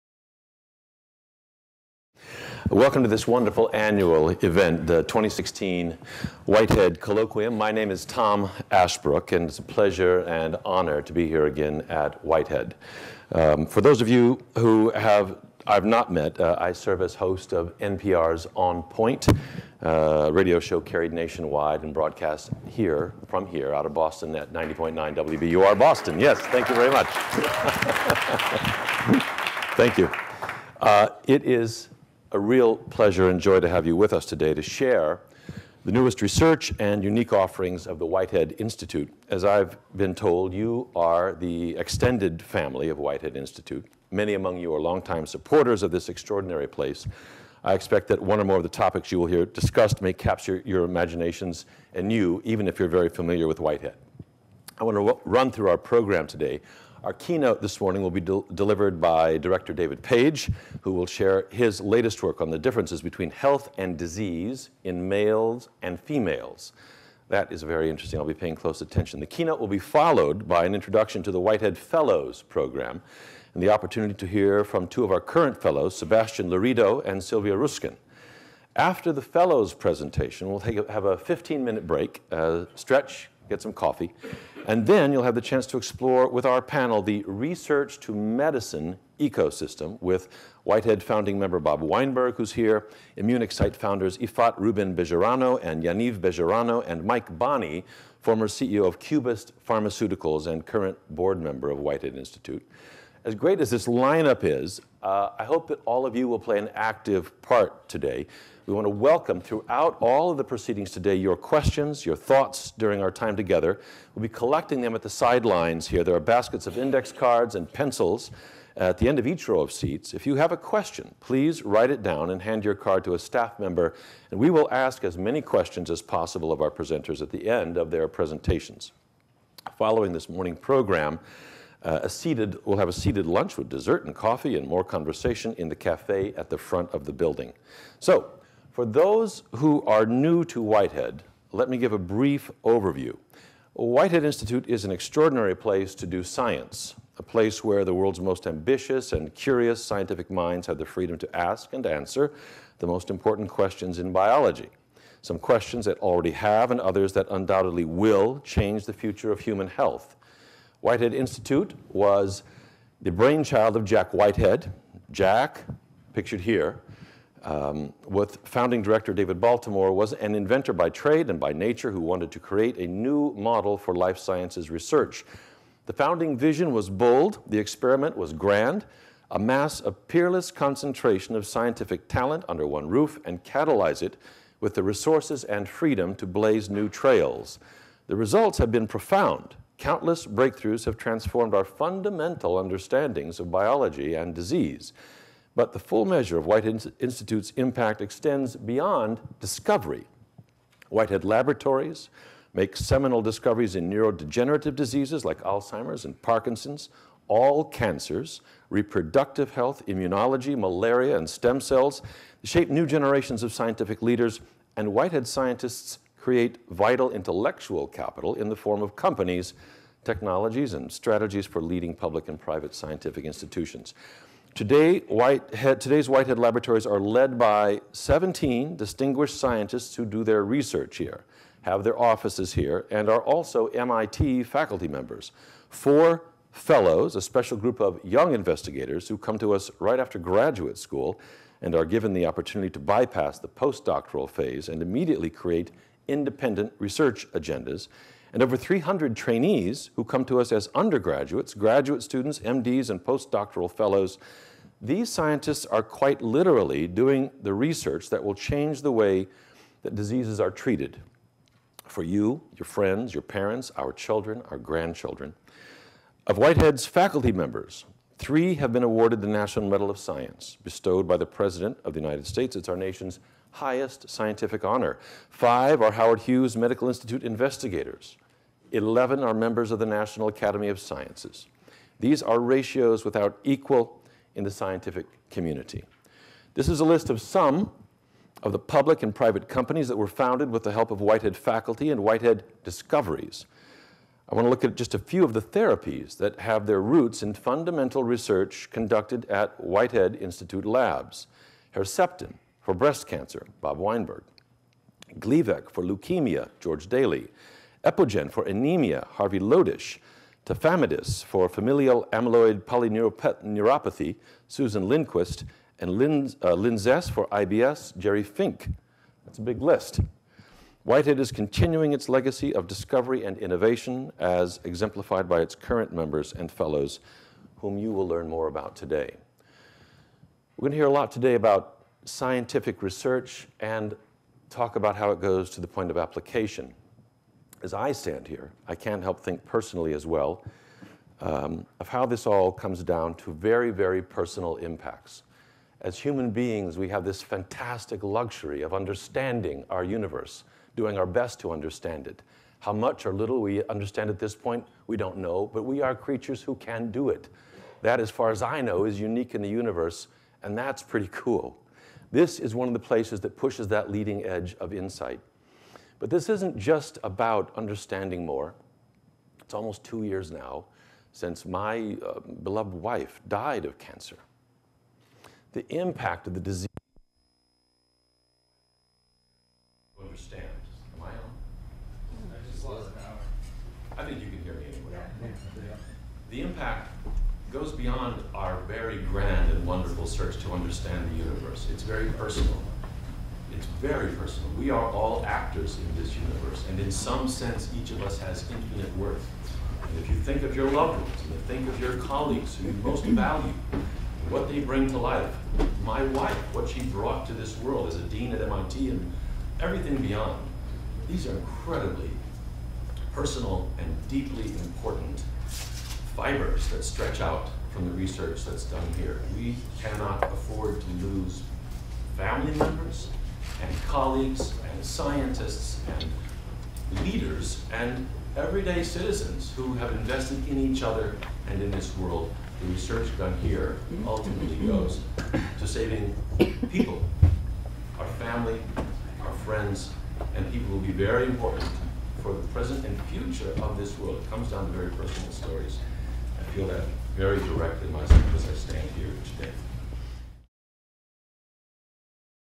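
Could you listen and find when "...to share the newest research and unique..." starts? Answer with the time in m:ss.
0:34.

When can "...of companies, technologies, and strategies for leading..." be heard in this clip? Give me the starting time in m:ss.
3:38.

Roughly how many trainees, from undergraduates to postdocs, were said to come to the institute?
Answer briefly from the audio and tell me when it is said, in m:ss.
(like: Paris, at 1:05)
over 300, at 4:08.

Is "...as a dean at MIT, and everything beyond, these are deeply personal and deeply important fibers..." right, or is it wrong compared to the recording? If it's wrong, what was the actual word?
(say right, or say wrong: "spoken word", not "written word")
wrong: "incredibly", not "deeply".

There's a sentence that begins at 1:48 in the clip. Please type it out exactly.
We want to welcome throughout all of the proceedings today your questions, your thoughts during our time together.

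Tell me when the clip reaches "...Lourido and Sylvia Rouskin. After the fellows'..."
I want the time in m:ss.
1:16.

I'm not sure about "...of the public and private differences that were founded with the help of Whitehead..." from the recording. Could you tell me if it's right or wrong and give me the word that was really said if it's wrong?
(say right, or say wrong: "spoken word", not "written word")
wrong: "companies", not "differences".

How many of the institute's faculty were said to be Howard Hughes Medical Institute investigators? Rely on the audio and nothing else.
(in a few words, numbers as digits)
Five.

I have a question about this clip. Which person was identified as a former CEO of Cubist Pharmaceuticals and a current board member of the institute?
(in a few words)
Mike Bonney.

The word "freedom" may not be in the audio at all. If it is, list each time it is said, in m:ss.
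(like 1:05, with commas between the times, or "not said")
2:30, 3:05.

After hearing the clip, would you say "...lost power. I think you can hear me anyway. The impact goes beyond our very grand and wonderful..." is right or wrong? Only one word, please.
right.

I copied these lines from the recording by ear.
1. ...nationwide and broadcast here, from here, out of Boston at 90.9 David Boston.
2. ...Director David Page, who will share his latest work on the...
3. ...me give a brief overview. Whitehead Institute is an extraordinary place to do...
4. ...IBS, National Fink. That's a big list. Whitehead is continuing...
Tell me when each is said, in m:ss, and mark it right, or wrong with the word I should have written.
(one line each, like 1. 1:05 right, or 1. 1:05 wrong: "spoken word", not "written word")
1. 0:21 wrong: "WBUR", not "David"
2. 0:59 right
3. 2:21 right
4. 5:17 wrong: "Jerry", not "National".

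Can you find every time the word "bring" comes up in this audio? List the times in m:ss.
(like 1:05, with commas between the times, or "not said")
6:44.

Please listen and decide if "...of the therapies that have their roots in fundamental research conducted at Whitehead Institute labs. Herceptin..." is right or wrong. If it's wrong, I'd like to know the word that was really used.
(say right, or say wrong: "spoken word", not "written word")
right.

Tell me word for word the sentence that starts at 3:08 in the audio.
The results have been profound countless breakthroughs have transformed our fundamental understandings of biology and disease.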